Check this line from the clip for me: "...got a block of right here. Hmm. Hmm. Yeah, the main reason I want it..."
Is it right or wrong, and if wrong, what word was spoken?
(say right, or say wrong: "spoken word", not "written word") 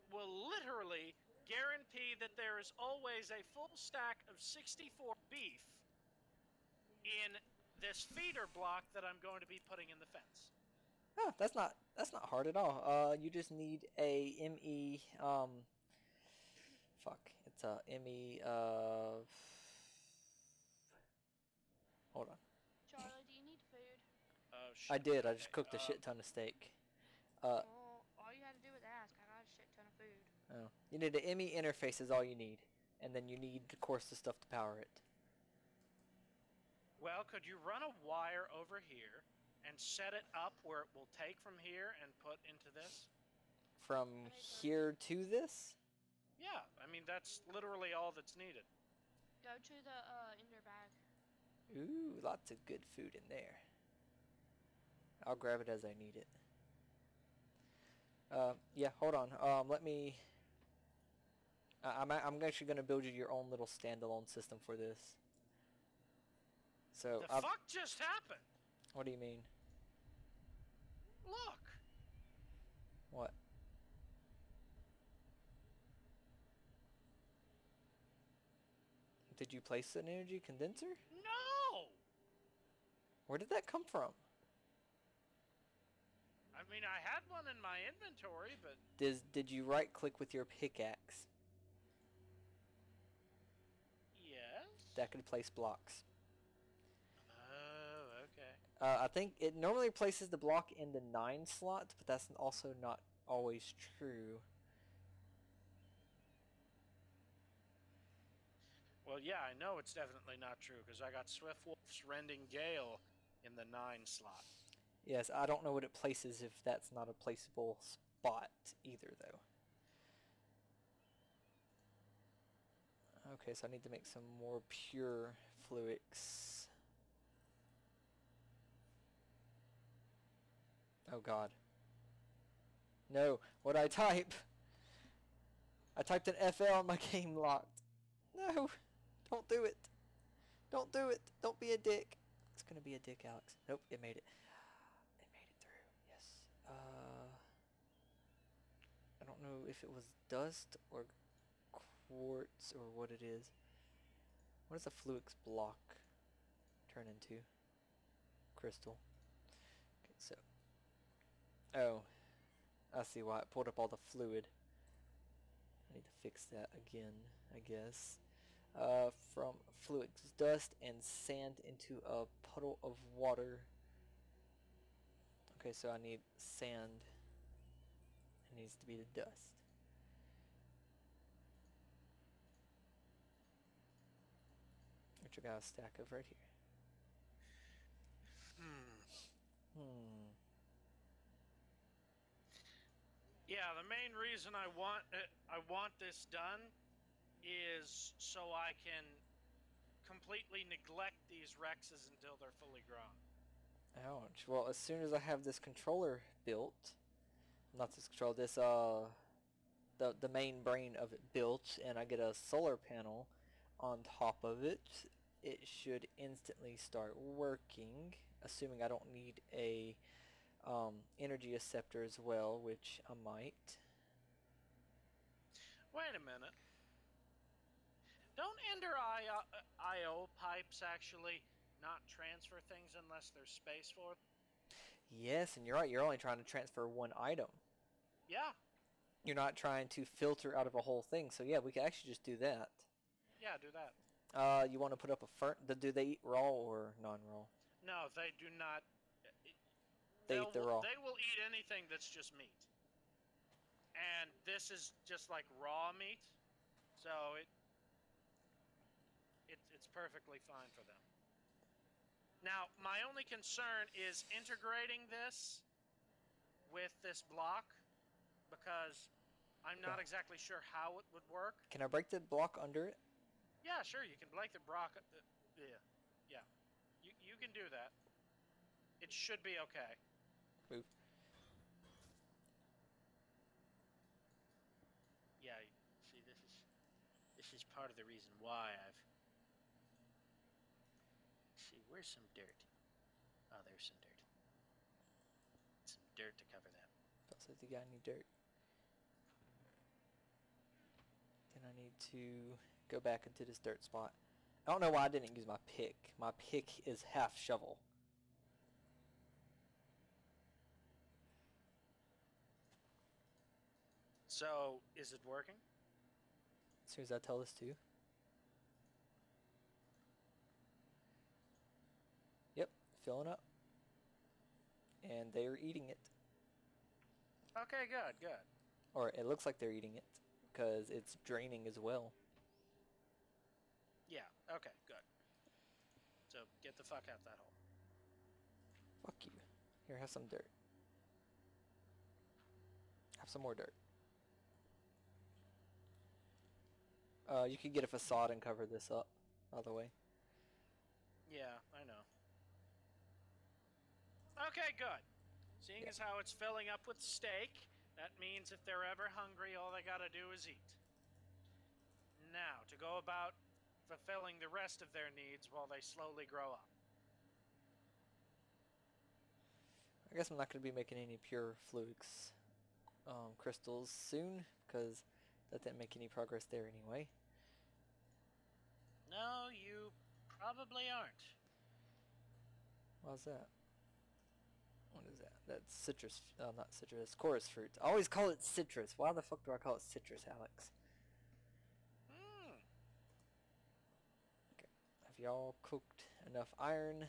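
wrong: "stack", not "block".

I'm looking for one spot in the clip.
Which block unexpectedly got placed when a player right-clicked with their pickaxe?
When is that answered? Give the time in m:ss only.
1:20.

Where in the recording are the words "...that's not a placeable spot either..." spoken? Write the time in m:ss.
1:56.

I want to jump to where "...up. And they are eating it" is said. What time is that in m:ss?
5:23.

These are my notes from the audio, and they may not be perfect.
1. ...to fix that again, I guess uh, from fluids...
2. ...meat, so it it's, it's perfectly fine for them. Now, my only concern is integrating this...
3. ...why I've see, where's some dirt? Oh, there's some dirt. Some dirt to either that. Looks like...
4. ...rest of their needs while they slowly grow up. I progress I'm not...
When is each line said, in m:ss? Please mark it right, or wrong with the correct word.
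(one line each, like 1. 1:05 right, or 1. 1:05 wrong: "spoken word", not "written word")
1. 2:46 right
2. 4:15 right
3. 4:48 wrong: "cover", not "either"
4. 6:04 wrong: "guess", not "progress".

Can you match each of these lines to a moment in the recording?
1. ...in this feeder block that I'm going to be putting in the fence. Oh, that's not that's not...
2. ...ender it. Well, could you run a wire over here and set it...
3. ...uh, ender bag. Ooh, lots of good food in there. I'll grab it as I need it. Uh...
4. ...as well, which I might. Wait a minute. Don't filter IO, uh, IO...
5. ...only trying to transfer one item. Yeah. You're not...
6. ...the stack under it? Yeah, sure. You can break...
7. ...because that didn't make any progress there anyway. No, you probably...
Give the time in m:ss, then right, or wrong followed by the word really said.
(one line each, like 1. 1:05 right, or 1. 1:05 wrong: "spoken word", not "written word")
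1. 0:07 right
2. 0:34 wrong: "power", not "ender"
3. 0:49 right
4. 3:42 wrong: "enter", not "filter"
5. 3:56 right
6. 4:32 wrong: "block", not "stack"
7. 6:14 right.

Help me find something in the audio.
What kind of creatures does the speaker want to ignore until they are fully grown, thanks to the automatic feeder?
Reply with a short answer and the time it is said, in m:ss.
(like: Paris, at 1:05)
Rexes, at 3:21.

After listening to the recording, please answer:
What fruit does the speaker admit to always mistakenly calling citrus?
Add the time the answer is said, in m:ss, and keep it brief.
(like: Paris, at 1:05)
Chorus fruit, at 6:27.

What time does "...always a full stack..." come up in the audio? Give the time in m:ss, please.
0:02.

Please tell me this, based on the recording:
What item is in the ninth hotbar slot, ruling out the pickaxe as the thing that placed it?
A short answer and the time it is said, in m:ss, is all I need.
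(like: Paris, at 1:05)
Swift Wolf's Rending Gale, at 1:51.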